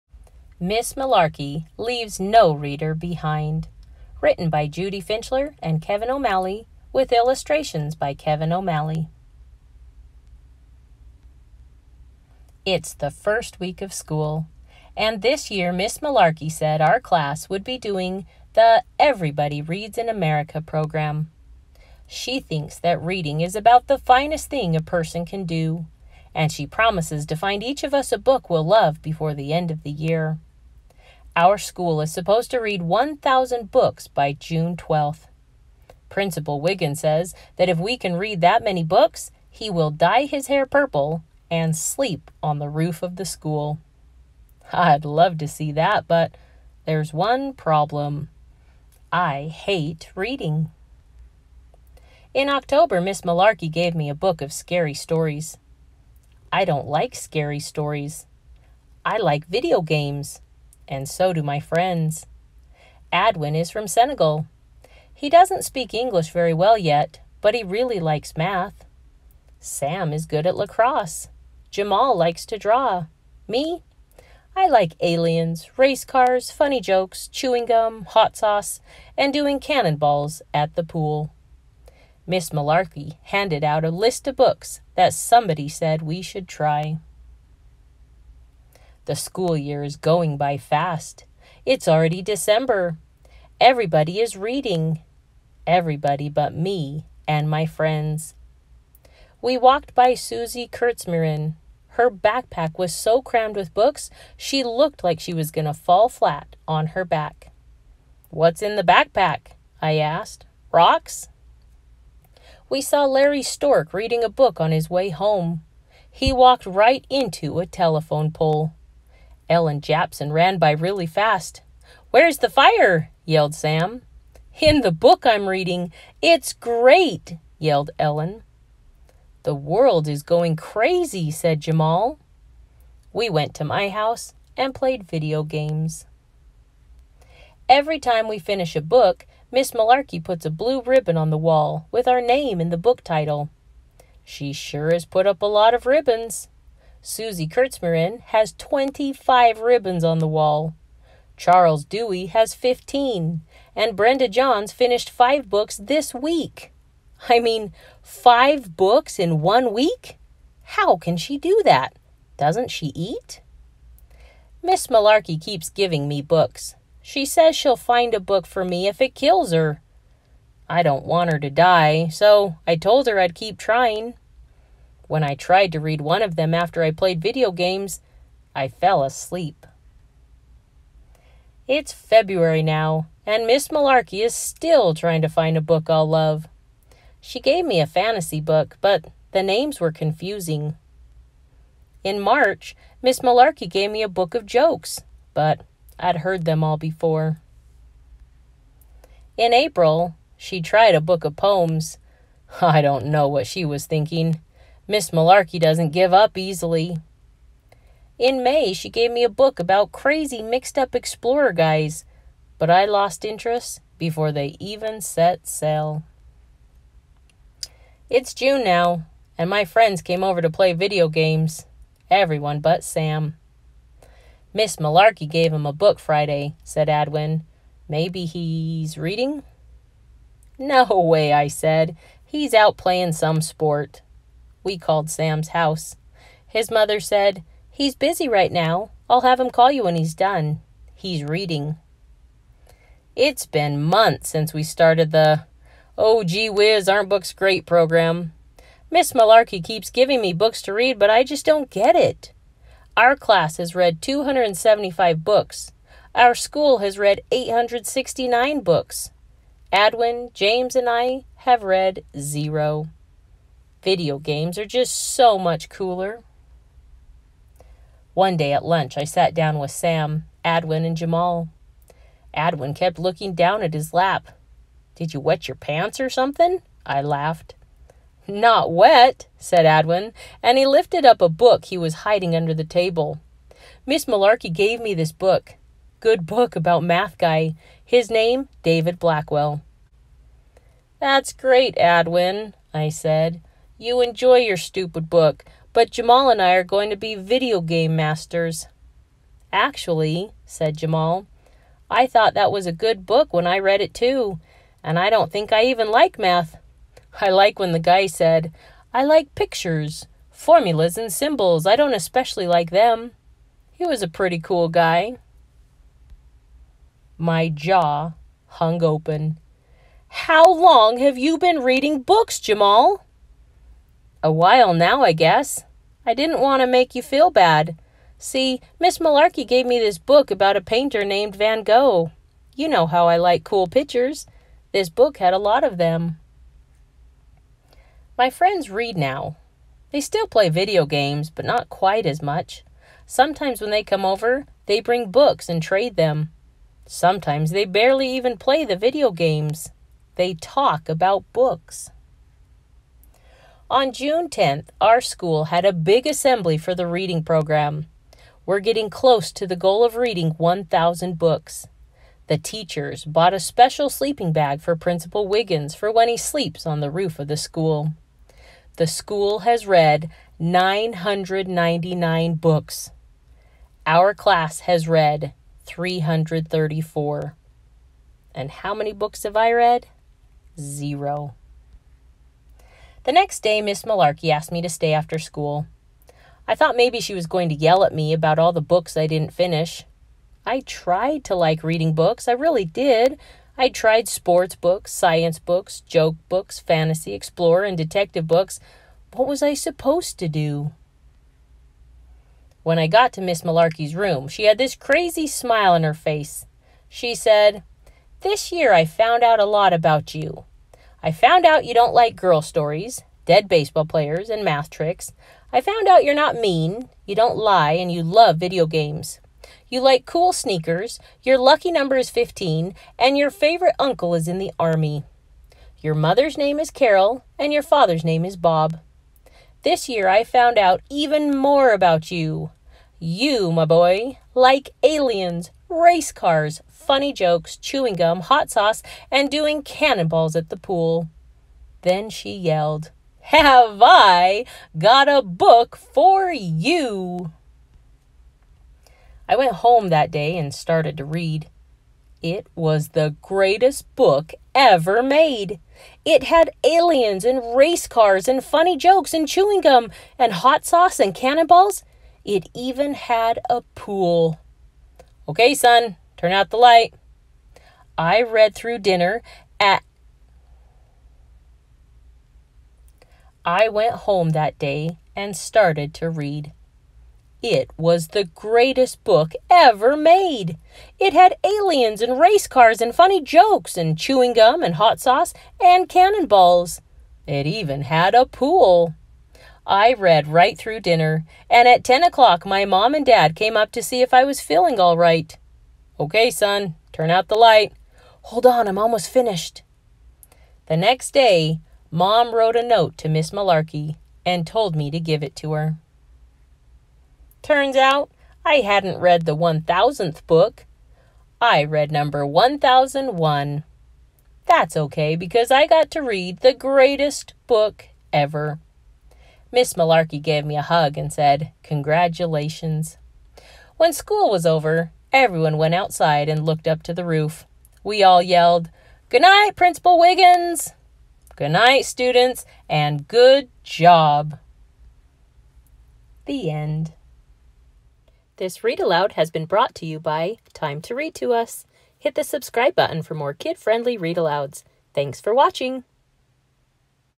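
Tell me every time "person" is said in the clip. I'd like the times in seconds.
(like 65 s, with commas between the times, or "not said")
24 s.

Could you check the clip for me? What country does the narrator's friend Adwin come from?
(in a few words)
Senegal.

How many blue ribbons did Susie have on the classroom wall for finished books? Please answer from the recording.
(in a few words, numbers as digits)
25.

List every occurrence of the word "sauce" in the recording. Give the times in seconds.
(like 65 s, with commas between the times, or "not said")
78 s, 438 s, 460 s, 484 s.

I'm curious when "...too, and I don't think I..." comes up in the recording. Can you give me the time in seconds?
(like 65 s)
303 s.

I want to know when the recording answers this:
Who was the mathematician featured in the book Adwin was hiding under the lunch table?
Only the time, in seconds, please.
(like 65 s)
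288 s.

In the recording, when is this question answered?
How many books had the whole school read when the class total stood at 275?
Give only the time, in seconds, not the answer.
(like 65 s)
257 s.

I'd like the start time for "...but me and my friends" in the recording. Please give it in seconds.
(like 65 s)
96 s.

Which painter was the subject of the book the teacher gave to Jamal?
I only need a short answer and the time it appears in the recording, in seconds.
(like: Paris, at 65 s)
Van Gogh, at 331 s.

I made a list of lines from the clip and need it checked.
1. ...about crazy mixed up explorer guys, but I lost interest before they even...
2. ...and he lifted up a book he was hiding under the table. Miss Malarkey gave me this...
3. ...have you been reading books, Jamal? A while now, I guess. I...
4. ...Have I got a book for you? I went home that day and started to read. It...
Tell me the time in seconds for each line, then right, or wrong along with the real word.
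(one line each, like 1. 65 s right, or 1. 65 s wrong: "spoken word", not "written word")
1. 209 s right
2. 280 s right
3. 320 s right
4. 443 s right.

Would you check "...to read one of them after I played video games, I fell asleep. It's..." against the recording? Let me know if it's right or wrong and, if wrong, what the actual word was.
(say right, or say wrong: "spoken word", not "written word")
right.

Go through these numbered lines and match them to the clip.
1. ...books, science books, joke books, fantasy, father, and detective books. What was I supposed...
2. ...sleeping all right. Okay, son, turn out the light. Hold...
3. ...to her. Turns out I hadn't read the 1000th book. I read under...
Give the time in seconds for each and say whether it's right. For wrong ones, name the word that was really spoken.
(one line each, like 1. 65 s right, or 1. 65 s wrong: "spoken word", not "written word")
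1. 394 s wrong: "explorer", not "father"
2. 494 s wrong: "feeling", not "sleeping"
3. 505 s wrong: "number", not "under".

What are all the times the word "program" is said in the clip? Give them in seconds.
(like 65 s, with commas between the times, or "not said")
20 s, 247 s, 357 s.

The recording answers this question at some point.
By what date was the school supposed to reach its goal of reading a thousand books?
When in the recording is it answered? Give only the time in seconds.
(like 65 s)
34 s.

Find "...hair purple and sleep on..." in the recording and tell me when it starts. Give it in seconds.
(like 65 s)
40 s.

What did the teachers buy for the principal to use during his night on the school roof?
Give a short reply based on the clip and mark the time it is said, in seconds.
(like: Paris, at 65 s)
sleeping bag, at 363 s.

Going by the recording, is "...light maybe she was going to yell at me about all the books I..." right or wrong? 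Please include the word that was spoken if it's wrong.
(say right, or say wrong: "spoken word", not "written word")
wrong: "thought", not "light".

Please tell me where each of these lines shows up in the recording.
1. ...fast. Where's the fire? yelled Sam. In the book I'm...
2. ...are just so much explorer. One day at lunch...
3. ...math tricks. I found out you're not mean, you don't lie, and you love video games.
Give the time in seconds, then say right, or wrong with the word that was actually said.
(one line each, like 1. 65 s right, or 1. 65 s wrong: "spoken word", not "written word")
1. 121 s right
2. 264 s wrong: "cooler", not "explorer"
3. 414 s right.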